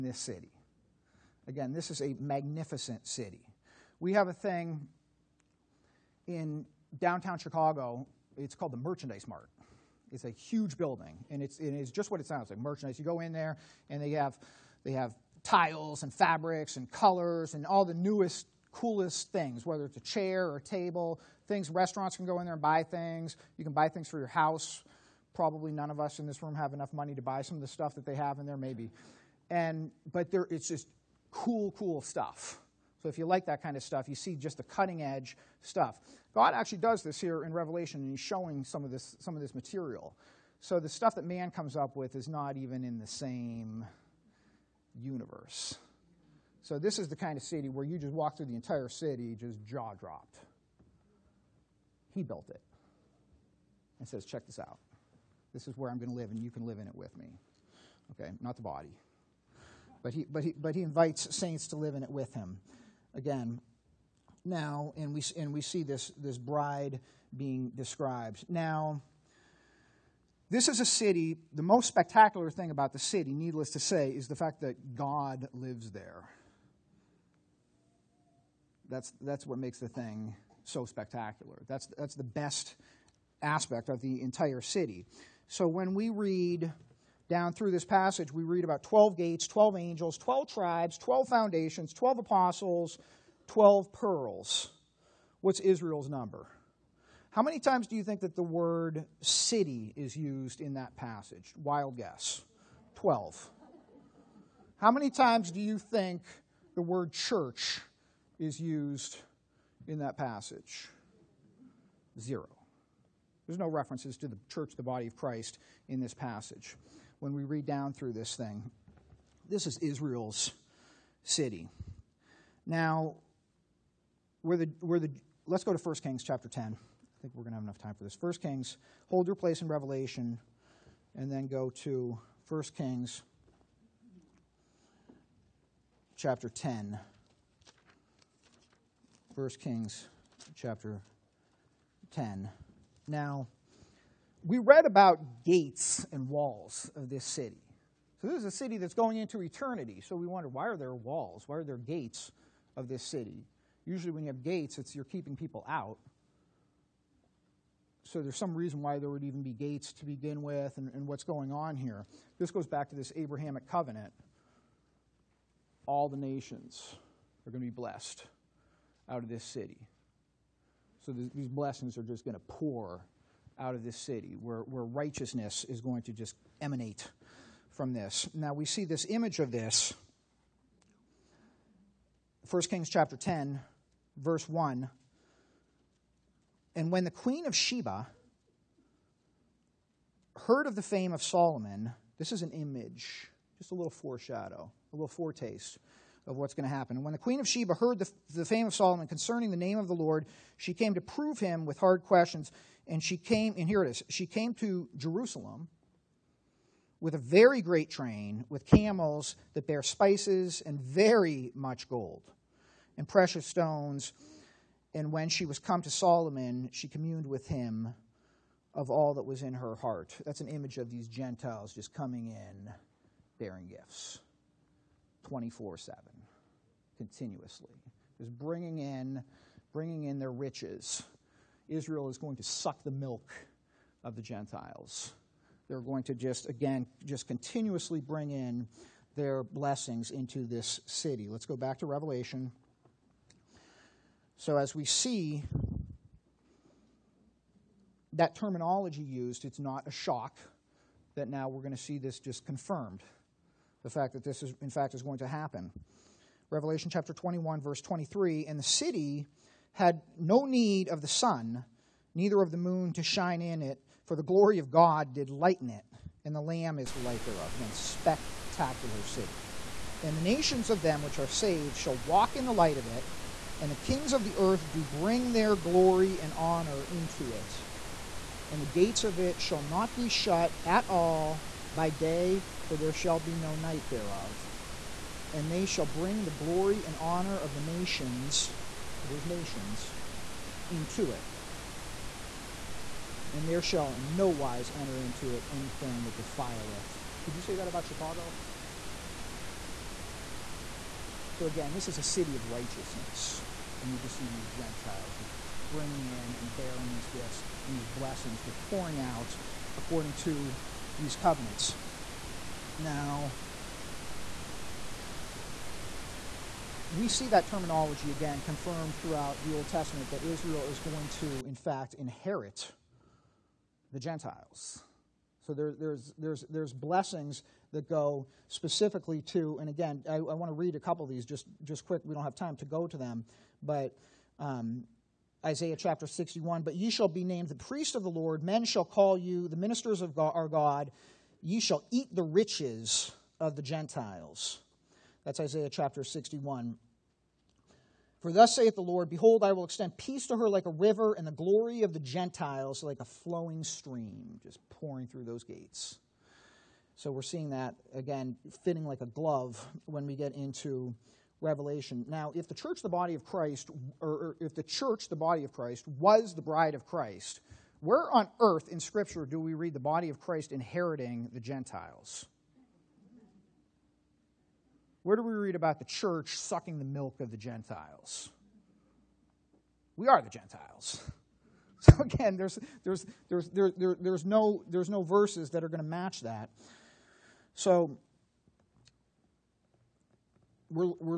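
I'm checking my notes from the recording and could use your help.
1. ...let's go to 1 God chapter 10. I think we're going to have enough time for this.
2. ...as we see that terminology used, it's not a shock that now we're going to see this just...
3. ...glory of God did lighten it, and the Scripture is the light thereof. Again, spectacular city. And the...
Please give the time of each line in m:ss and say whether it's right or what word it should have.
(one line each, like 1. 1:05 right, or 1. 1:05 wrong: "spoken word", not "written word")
1. 2:05 wrong: "Kings", not "God"
2. 4:04 right
3. 4:24 wrong: "Lamb", not "Scripture".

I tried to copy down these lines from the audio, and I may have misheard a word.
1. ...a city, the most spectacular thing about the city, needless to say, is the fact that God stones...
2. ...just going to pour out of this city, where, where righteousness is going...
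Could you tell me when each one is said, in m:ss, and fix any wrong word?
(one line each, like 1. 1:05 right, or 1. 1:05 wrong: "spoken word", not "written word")
1. 1:10 wrong: "lives", not "stones"
2. 2:52 right.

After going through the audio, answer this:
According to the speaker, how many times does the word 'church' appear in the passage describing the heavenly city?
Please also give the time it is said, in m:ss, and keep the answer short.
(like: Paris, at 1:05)
0, at 1:52.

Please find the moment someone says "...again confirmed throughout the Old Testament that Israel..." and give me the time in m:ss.
5:18.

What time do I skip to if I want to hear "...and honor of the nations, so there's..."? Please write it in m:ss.
4:46.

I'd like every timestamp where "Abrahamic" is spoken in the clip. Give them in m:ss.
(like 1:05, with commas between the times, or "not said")
2:43.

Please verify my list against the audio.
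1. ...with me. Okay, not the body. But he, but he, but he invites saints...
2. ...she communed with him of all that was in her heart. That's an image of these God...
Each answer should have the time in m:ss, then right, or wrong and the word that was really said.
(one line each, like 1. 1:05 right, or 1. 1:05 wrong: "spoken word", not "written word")
1. 0:56 right
2. 3:36 wrong: "Gentiles", not "God".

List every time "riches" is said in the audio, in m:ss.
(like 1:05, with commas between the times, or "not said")
3:50, 5:42.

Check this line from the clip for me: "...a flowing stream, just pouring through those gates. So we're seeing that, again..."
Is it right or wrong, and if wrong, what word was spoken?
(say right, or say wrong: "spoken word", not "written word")
right.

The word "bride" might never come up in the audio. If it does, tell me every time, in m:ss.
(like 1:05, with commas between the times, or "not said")
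1:06, 6:06.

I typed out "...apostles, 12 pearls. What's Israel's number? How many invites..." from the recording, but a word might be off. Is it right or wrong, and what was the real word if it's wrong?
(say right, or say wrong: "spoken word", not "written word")
wrong: "times", not "invites".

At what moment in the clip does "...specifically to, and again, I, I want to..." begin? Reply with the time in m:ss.
5:28.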